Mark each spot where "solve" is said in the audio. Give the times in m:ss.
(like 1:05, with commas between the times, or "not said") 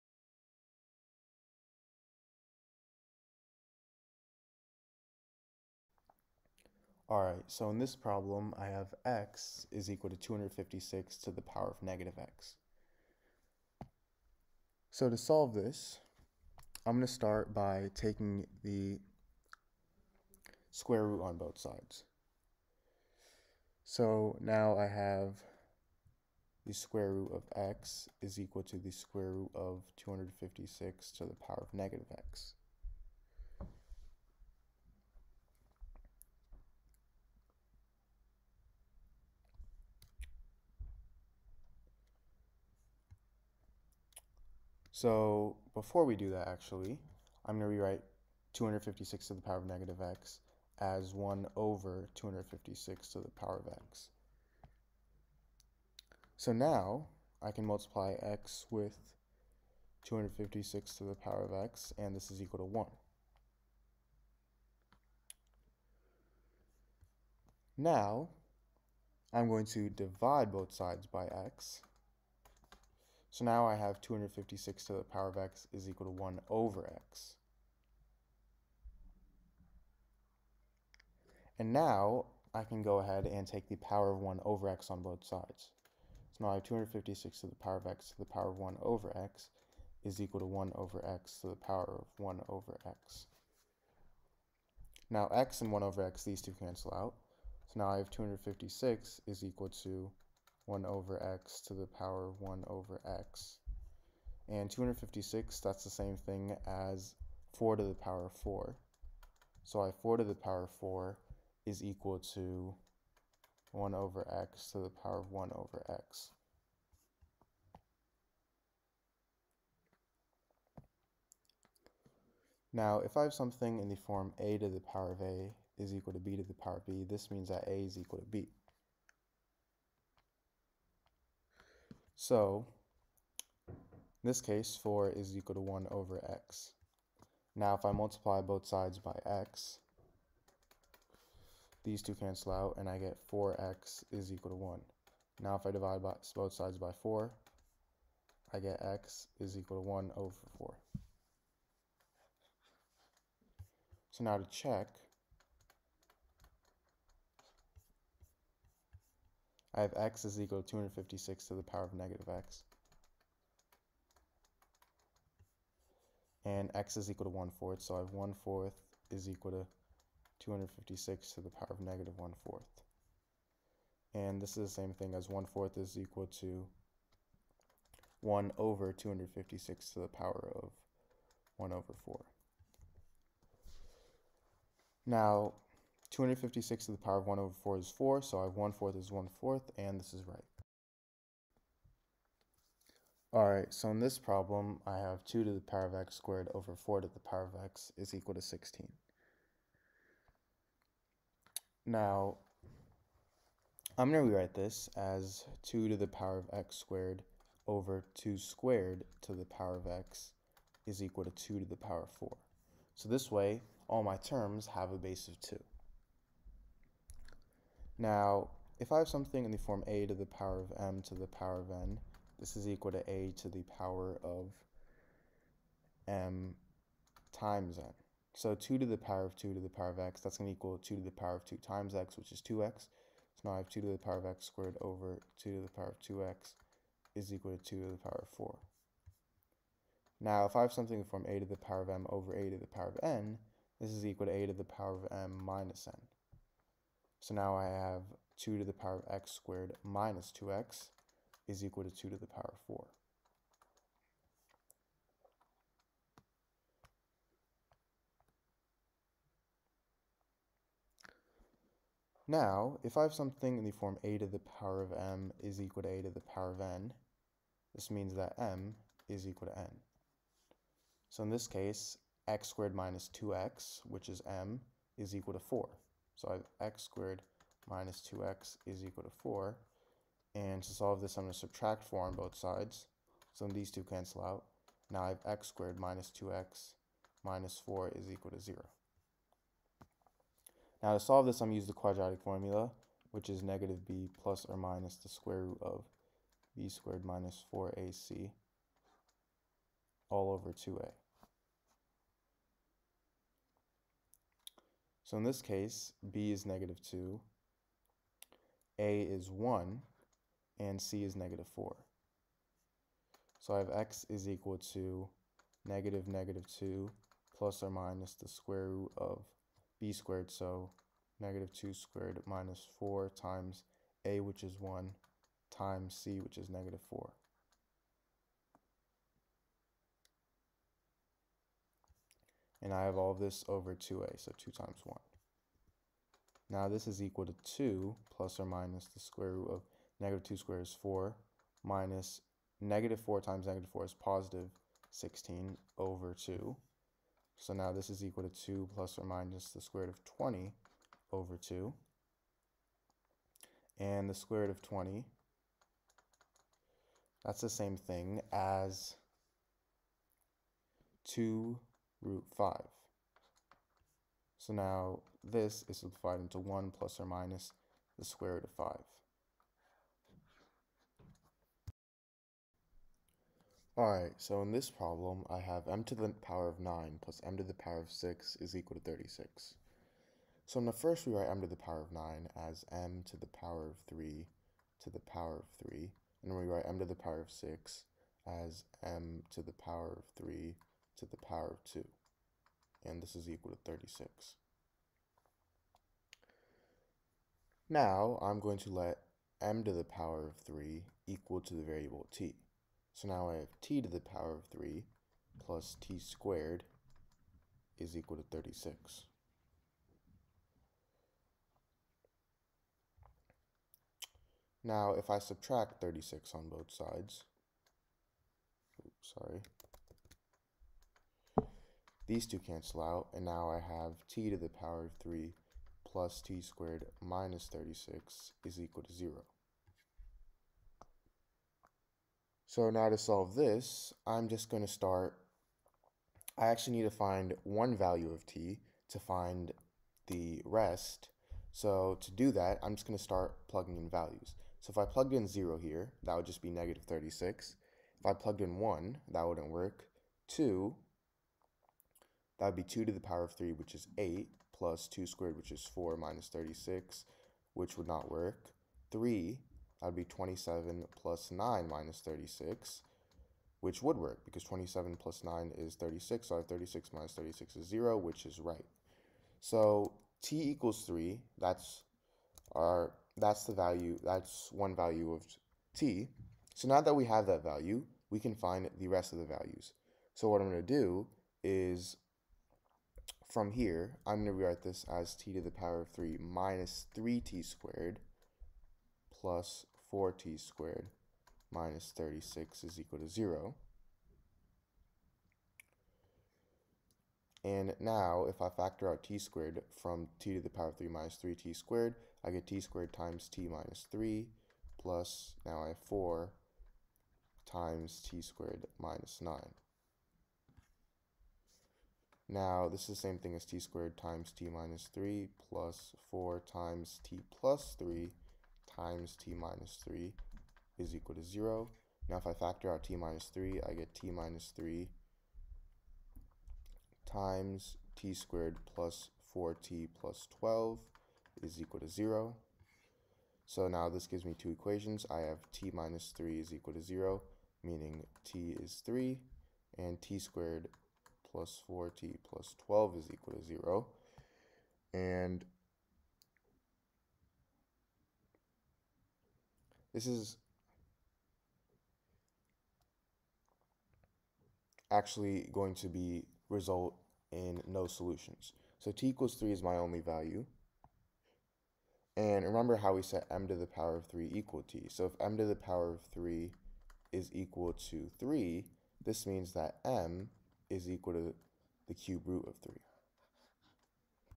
0:15, 4:40, 4:50, 7:12.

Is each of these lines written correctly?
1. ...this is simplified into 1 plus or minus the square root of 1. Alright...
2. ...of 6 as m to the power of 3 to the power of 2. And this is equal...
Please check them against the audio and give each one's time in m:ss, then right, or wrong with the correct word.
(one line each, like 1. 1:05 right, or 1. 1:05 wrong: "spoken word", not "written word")
1. 6:05 wrong: "5", not "1"
2. 6:27 right.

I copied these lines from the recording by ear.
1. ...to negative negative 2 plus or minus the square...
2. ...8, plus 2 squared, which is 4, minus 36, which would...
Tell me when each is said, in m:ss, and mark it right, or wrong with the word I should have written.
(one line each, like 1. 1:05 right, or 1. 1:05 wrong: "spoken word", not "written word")
1. 5:14 right
2. 7:33 right.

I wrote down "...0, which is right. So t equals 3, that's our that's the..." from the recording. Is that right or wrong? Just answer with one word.
right.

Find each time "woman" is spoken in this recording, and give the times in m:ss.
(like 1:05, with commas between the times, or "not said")
not said.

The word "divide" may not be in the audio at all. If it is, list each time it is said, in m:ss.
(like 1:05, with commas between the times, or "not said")
1:09, 2:25.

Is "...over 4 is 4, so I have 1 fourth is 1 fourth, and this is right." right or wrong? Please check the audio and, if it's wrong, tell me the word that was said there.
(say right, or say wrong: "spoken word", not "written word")
right.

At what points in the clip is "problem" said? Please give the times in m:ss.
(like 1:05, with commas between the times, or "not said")
0:07, 3:14, 6:14.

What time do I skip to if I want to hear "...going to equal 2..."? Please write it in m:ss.
3:50.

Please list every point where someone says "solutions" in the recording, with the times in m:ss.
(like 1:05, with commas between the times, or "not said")
9:17.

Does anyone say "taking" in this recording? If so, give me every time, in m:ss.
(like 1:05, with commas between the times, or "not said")
0:17.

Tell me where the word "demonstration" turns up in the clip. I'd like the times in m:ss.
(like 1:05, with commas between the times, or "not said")
not said.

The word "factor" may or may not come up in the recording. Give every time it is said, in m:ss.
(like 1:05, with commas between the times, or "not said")
8:18, 8:42.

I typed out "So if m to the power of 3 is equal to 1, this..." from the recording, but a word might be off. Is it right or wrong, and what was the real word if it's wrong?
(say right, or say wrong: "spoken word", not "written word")
wrong: "3", not "1".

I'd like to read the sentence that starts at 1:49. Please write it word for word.
So I 4 to the power 4 is equal to 1 over x to the power of 1 over x.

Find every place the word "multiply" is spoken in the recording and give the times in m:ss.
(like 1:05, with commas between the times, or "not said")
0:57, 2:17.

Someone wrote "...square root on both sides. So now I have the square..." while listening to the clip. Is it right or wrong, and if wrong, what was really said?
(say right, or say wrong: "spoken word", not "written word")
right.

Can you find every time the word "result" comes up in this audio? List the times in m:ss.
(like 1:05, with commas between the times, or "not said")
9:16.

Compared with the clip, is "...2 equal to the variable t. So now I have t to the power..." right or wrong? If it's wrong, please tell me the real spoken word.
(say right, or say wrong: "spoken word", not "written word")
wrong: "3", not "2".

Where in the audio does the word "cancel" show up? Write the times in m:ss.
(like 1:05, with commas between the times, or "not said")
1:36, 2:22, 4:43, 7:02.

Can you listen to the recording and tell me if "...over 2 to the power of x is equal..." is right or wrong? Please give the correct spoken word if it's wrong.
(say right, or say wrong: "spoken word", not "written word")
wrong: "4", not "2".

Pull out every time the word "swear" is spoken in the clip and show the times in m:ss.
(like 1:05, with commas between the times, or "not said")
not said.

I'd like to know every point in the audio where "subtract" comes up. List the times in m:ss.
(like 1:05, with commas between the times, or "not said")
4:41, 6:55.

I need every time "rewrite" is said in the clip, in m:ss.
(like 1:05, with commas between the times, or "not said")
0:47, 3:24, 6:21, 8:04.